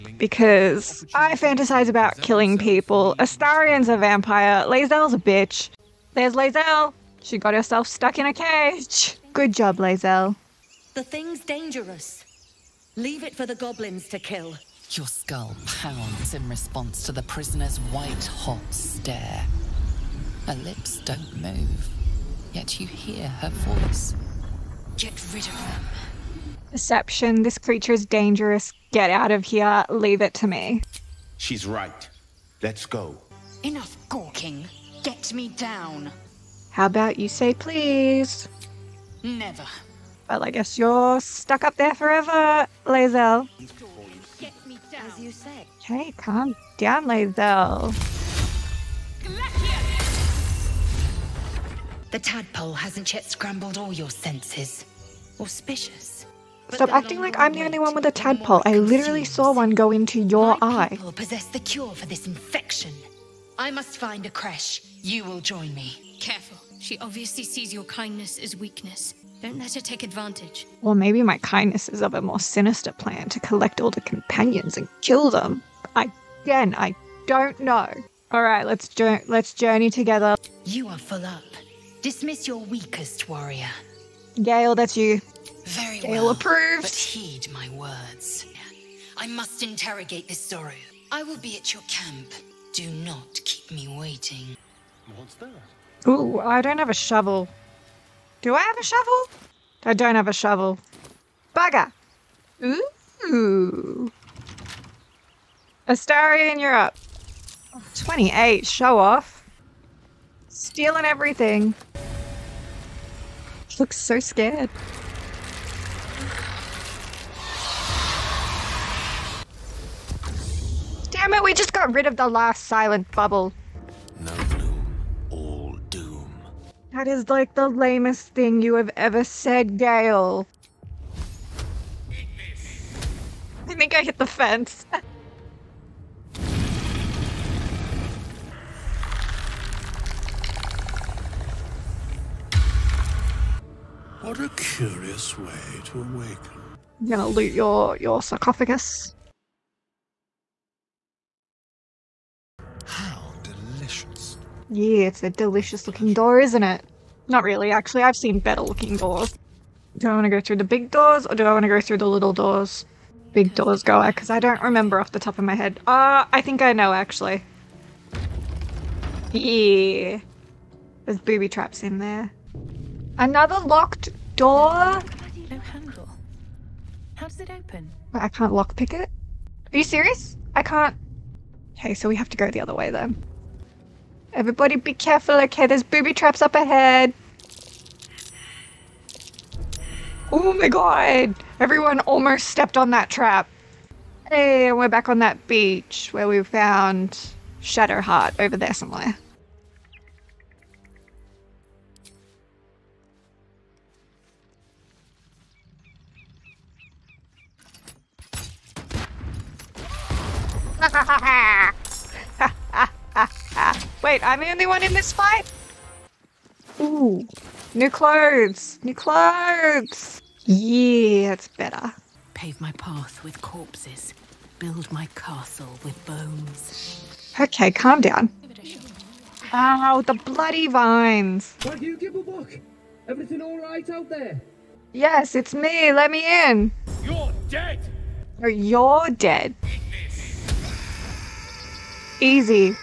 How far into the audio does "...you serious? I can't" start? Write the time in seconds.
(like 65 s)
179 s.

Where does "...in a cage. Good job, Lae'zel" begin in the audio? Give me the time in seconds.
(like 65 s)
8 s.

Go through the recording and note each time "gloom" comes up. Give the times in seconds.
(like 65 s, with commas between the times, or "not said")
124 s.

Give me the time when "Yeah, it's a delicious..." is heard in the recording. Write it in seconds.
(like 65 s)
154 s.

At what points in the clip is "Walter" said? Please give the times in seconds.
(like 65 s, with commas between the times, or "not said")
not said.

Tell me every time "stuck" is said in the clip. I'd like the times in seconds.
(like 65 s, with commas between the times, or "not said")
7 s, 41 s.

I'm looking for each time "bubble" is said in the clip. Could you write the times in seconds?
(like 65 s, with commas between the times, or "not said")
123 s.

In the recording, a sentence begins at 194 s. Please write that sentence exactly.
Hey, and we're back on that beach where we found Shadowheart over there somewhere.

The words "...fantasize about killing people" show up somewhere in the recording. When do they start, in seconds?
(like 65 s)
1 s.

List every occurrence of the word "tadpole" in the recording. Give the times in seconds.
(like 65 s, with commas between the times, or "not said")
52 s, 58 s.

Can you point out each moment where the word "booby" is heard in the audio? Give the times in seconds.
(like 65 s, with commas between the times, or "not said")
171 s, 185 s.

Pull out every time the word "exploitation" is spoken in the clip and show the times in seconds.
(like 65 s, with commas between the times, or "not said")
not said.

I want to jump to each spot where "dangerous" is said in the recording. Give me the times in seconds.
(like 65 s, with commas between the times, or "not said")
11 s, 28 s.